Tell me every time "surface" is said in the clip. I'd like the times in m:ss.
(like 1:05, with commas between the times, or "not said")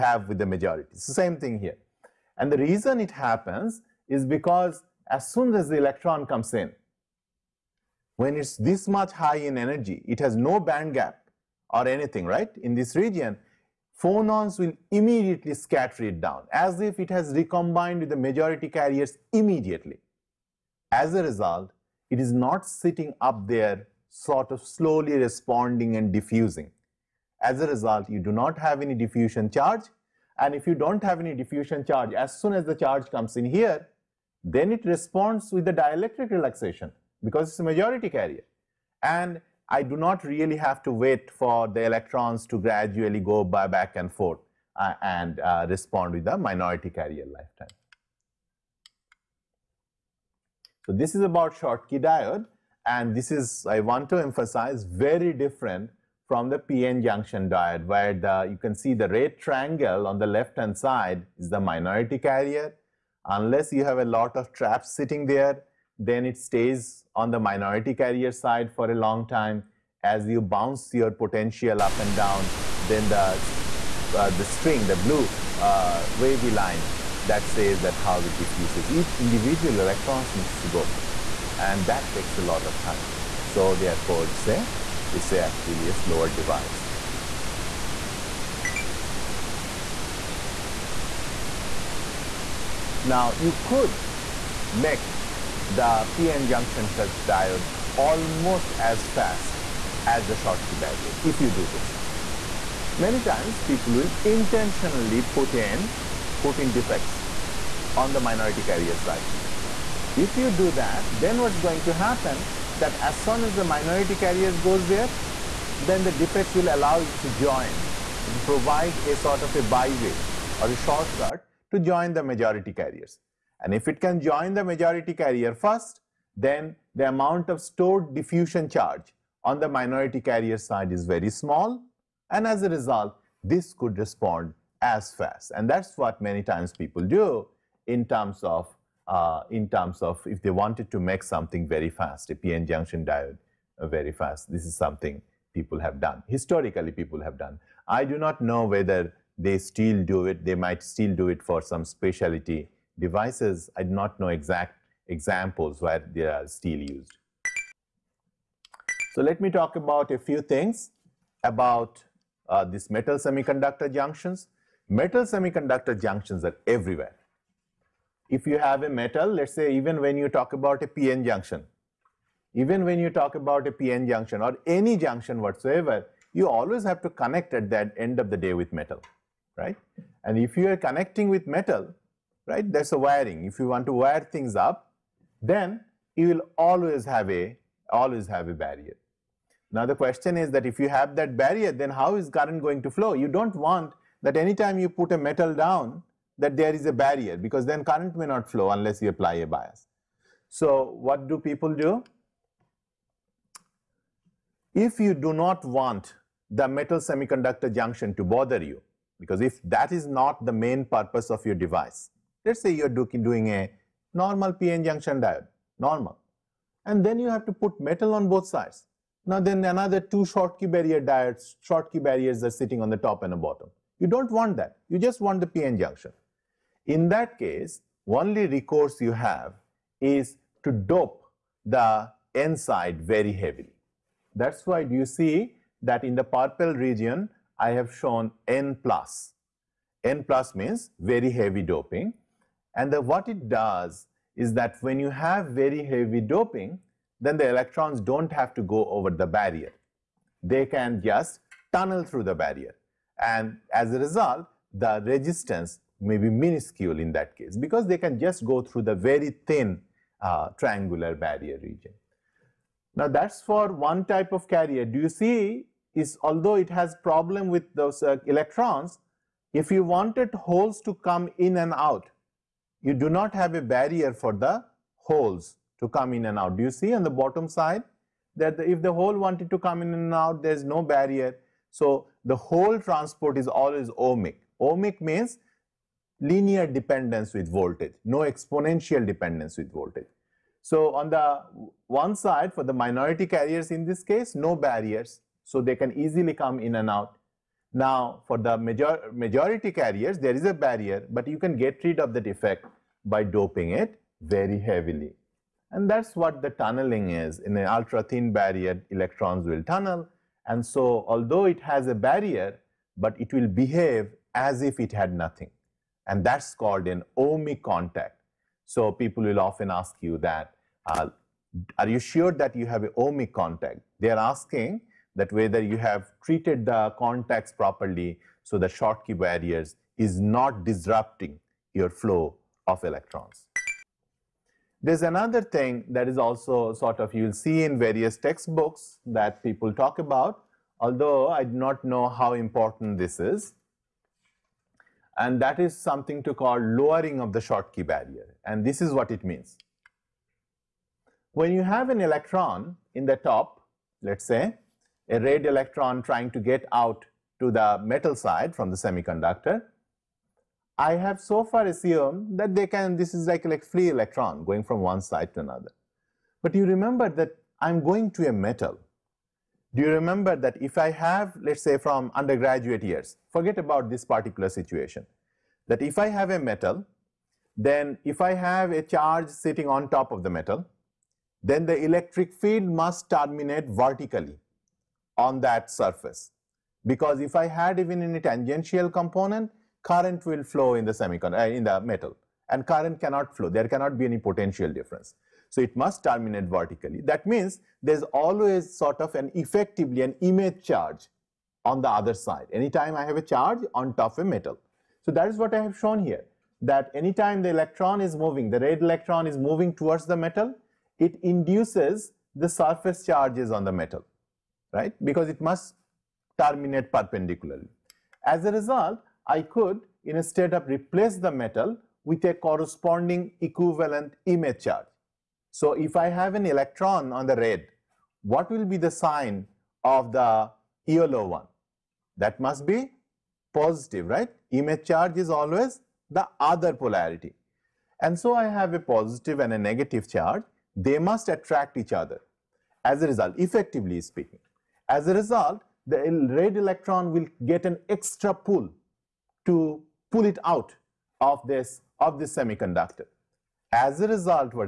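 6:25, 6:52.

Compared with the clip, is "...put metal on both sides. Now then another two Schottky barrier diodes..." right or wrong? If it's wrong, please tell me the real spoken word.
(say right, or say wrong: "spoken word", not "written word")
right.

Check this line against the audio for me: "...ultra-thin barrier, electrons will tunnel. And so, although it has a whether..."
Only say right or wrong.
wrong.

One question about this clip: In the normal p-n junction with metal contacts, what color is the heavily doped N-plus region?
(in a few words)
Purple.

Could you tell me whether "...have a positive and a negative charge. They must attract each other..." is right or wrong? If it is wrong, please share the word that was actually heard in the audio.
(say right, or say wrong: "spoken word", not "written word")
right.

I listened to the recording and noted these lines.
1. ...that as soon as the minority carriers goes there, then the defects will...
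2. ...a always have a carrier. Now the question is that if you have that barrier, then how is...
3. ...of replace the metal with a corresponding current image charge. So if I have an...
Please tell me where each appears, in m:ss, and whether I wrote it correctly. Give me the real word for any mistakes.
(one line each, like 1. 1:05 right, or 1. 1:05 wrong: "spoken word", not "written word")
1. 1:52 right
2. 3:07 wrong: "barrier", not "carrier"
3. 7:00 wrong: "equivalent", not "current".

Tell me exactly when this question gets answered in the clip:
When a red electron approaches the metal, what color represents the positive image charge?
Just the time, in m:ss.
7:10.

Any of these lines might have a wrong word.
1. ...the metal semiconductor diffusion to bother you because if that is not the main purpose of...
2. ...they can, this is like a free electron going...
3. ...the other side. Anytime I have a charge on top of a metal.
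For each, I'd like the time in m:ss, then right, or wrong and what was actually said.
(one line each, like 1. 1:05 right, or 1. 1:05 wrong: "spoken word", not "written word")
1. 3:26 wrong: "junction", not "diffusion"
2. 6:02 right
3. 6:41 right.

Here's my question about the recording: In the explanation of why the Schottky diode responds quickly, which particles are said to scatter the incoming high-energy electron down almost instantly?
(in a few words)
Phonons.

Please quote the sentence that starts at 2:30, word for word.
They might still do it for some speciality devices, I do not know exact examples where they are still used.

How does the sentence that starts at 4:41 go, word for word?
So the whole transport is always ohmic.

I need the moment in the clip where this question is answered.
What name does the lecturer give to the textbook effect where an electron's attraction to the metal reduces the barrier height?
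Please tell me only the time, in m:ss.
5:46.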